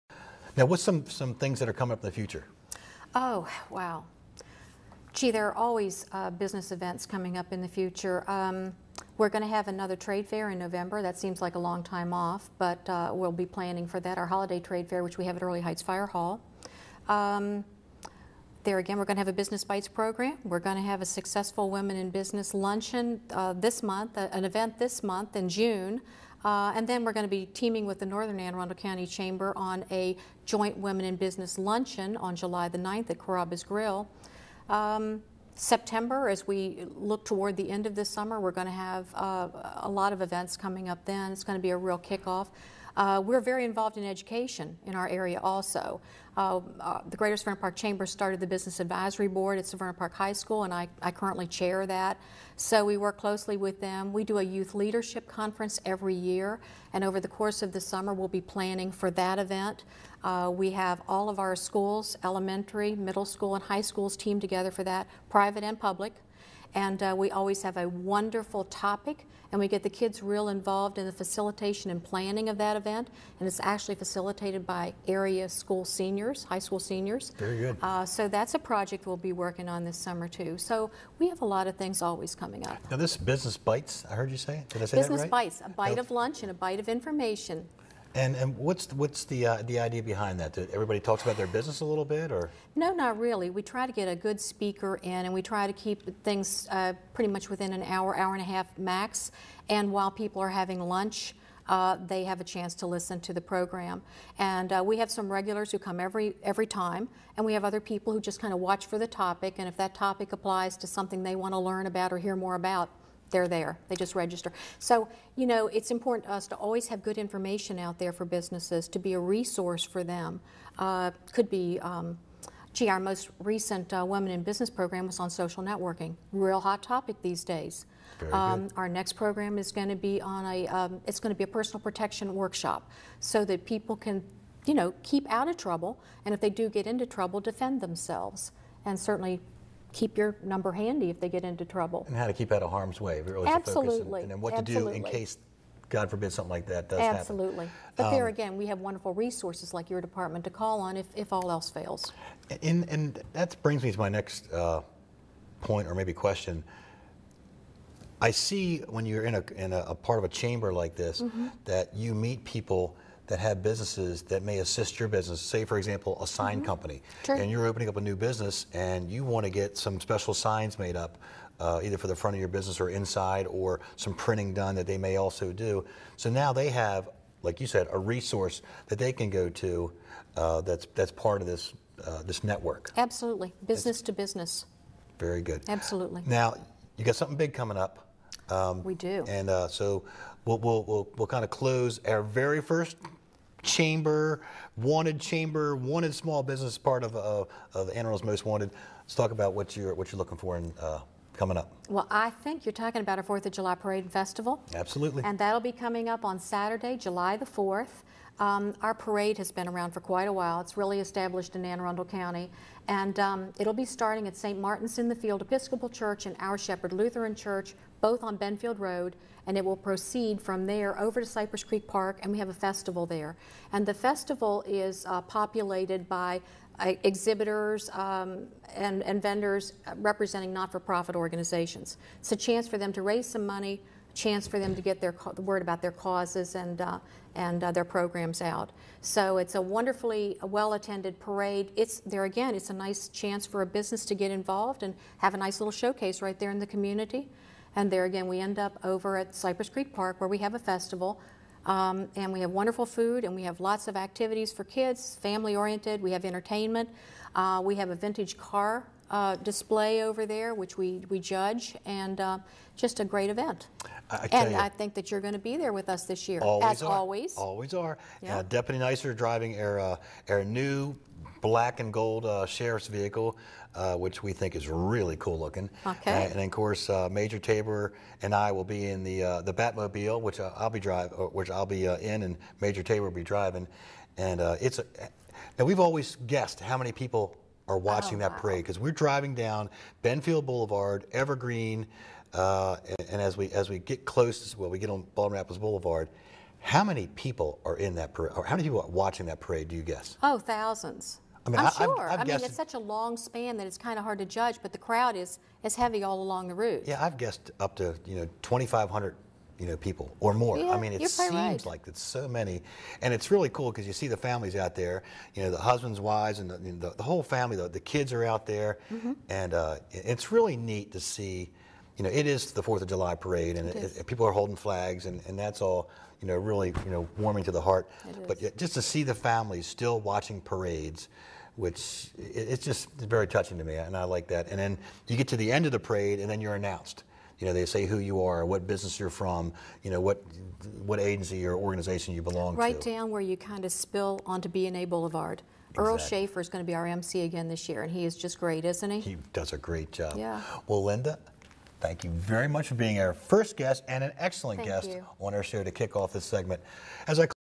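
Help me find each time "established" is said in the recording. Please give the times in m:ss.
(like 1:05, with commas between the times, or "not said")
3:30.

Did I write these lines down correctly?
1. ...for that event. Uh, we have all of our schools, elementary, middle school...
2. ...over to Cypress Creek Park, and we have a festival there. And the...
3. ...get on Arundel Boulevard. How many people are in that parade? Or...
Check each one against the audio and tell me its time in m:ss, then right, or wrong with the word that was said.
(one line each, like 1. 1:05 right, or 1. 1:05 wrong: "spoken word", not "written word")
1. 0:58 right
2. 3:40 right
3. 4:54 wrong: "Baltimore", not "Arundel".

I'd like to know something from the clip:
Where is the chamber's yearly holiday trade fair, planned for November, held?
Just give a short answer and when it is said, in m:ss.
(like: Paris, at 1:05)
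Earleigh Heights Fire Hall, at 0:15.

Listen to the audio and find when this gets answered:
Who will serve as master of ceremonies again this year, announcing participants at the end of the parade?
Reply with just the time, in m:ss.
5:45.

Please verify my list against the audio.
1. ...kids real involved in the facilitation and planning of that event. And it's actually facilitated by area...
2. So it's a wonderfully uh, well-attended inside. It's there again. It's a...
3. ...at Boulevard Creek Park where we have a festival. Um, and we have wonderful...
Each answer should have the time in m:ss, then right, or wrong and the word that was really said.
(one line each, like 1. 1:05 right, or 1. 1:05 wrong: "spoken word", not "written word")
1. 1:09 right
2. 3:59 wrong: "parade", not "inside"
3. 4:09 wrong: "Cypress", not "Boulevard".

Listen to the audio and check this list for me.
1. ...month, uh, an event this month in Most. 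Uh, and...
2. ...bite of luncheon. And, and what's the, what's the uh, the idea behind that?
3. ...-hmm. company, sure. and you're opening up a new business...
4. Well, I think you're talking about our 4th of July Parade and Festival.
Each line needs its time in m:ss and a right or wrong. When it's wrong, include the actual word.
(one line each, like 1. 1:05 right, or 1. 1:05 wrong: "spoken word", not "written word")
1. 0:23 wrong: "June", not "Most"
2. 1:26 wrong: "information", not "luncheon"
3. 2:46 right
4. 3:21 right.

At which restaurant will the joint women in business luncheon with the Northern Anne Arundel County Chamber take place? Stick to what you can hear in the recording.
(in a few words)
Carrabba's Grill.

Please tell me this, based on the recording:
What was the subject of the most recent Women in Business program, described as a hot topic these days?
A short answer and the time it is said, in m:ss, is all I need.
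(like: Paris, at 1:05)
Social networking, at 2:05.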